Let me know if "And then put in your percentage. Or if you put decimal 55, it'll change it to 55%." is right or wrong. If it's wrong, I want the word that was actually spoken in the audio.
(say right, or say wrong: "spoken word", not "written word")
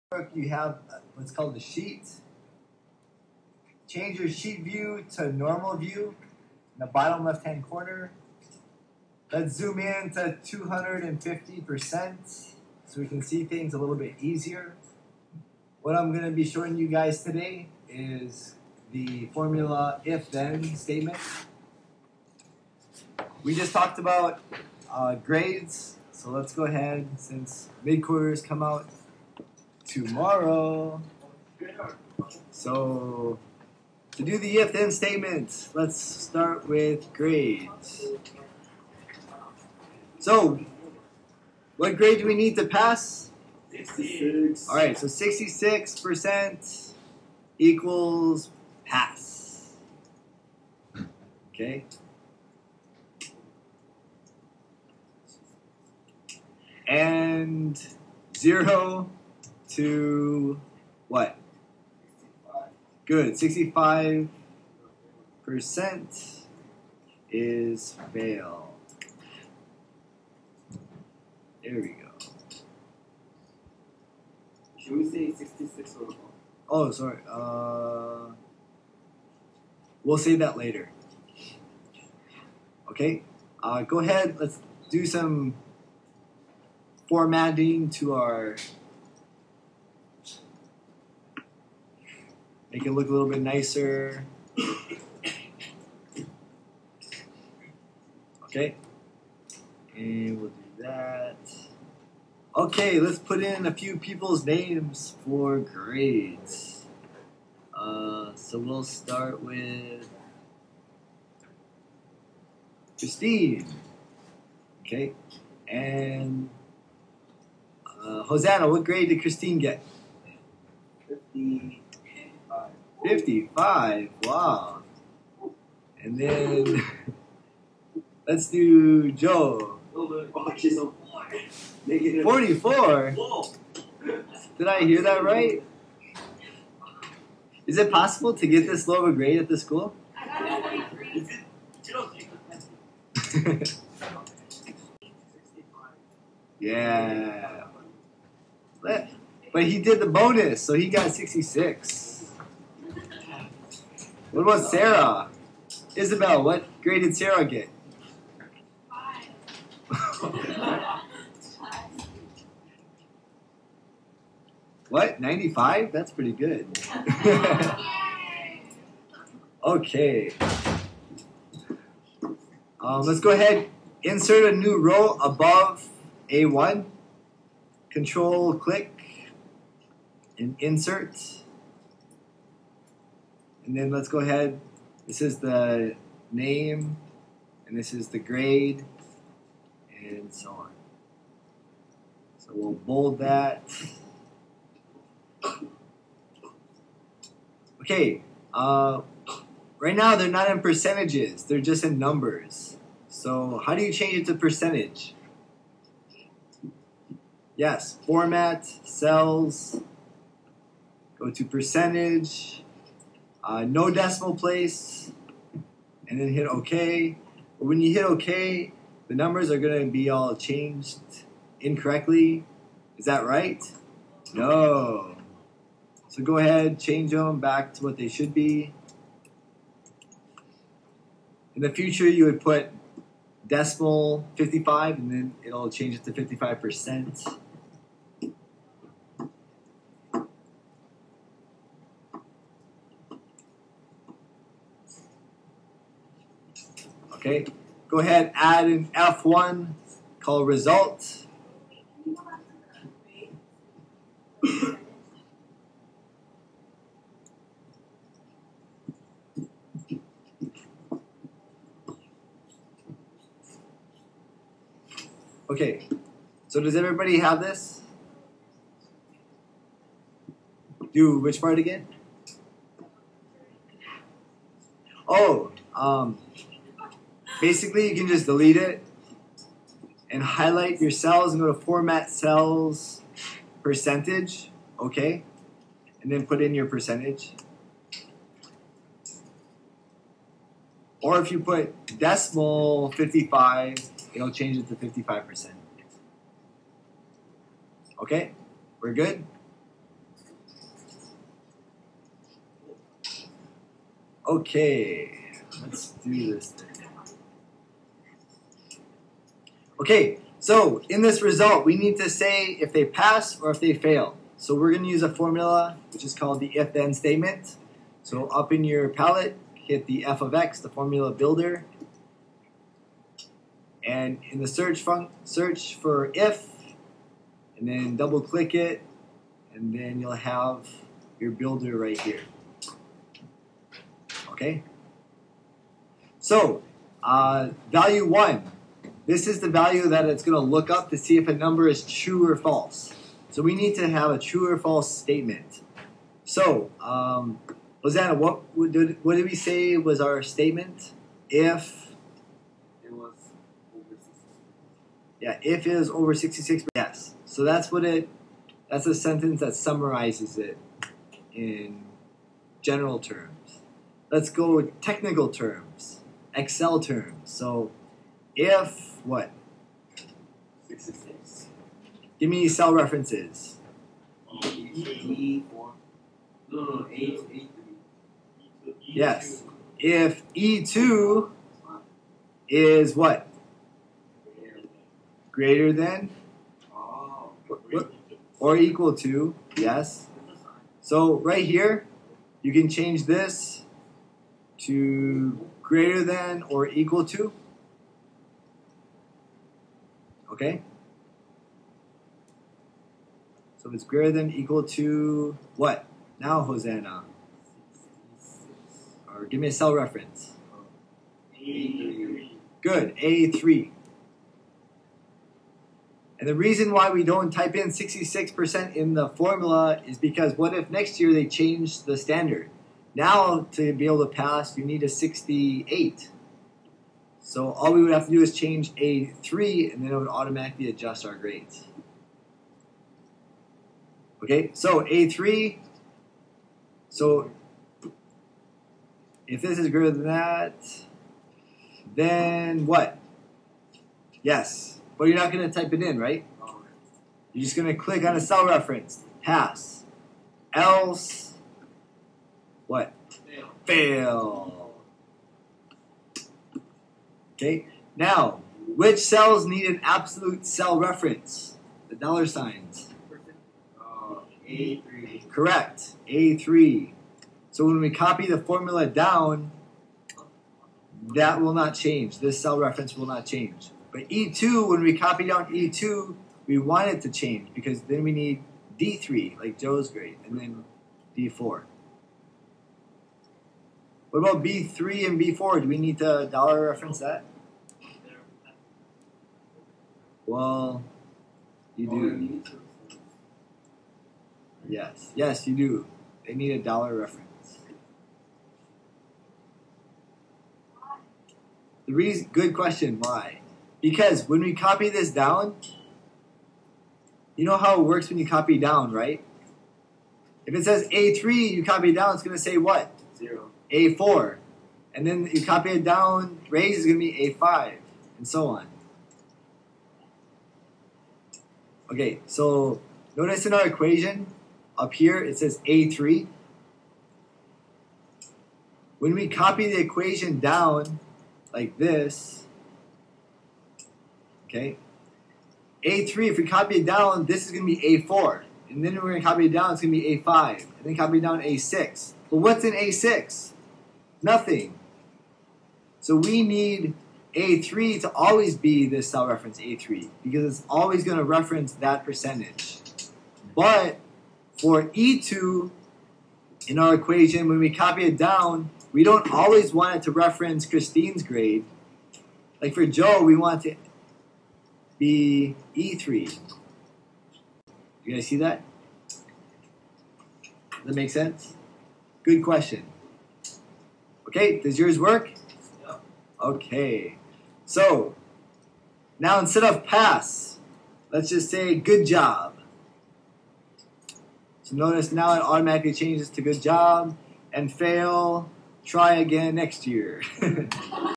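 right.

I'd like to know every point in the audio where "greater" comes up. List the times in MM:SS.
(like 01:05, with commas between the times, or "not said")
06:25, 06:35, 06:43, 07:19.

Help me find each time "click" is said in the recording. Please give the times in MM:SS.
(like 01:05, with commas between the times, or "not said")
02:58, 05:28, 07:27.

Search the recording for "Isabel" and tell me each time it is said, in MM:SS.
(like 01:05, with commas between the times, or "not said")
02:35.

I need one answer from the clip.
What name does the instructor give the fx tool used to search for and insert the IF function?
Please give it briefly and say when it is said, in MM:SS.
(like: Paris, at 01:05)
formula builder, at 05:20.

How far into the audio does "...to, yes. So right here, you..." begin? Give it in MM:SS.
06:28.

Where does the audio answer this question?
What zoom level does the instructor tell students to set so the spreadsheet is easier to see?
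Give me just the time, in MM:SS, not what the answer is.
00:10.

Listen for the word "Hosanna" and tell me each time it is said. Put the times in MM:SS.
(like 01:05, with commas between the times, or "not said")
01:58, 06:46.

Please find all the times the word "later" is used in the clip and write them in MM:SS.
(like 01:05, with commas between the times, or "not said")
01:20.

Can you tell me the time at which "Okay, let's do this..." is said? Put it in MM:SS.
05:04.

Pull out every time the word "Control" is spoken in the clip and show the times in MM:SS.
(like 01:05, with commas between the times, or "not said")
02:57.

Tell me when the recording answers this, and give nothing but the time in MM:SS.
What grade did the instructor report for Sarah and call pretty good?
02:45.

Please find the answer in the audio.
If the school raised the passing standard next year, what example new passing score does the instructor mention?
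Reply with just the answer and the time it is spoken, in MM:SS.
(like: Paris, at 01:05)
68, at 07:04.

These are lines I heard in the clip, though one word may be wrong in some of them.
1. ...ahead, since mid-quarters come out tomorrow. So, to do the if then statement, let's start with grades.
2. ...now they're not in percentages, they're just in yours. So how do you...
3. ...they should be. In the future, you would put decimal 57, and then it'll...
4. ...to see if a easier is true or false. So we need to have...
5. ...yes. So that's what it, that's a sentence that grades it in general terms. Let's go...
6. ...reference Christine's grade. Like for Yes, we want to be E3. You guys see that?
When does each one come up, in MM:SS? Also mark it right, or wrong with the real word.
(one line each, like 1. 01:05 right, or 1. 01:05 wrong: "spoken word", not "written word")
1. 00:26 right
2. 03:19 wrong: "numbers", not "yours"
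3. 03:47 wrong: "55", not "57"
4. 05:40 wrong: "number", not "easier"
5. 05:56 wrong: "summarizes", not "grades"
6. 09:20 wrong: "Joe", not "Yes".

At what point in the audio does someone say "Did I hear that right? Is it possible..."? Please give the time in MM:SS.
02:14.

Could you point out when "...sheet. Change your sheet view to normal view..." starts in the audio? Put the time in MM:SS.
00:01.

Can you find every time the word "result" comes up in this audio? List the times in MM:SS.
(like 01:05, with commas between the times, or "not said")
04:10, 05:11.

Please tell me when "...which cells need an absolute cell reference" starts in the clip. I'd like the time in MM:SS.
07:38.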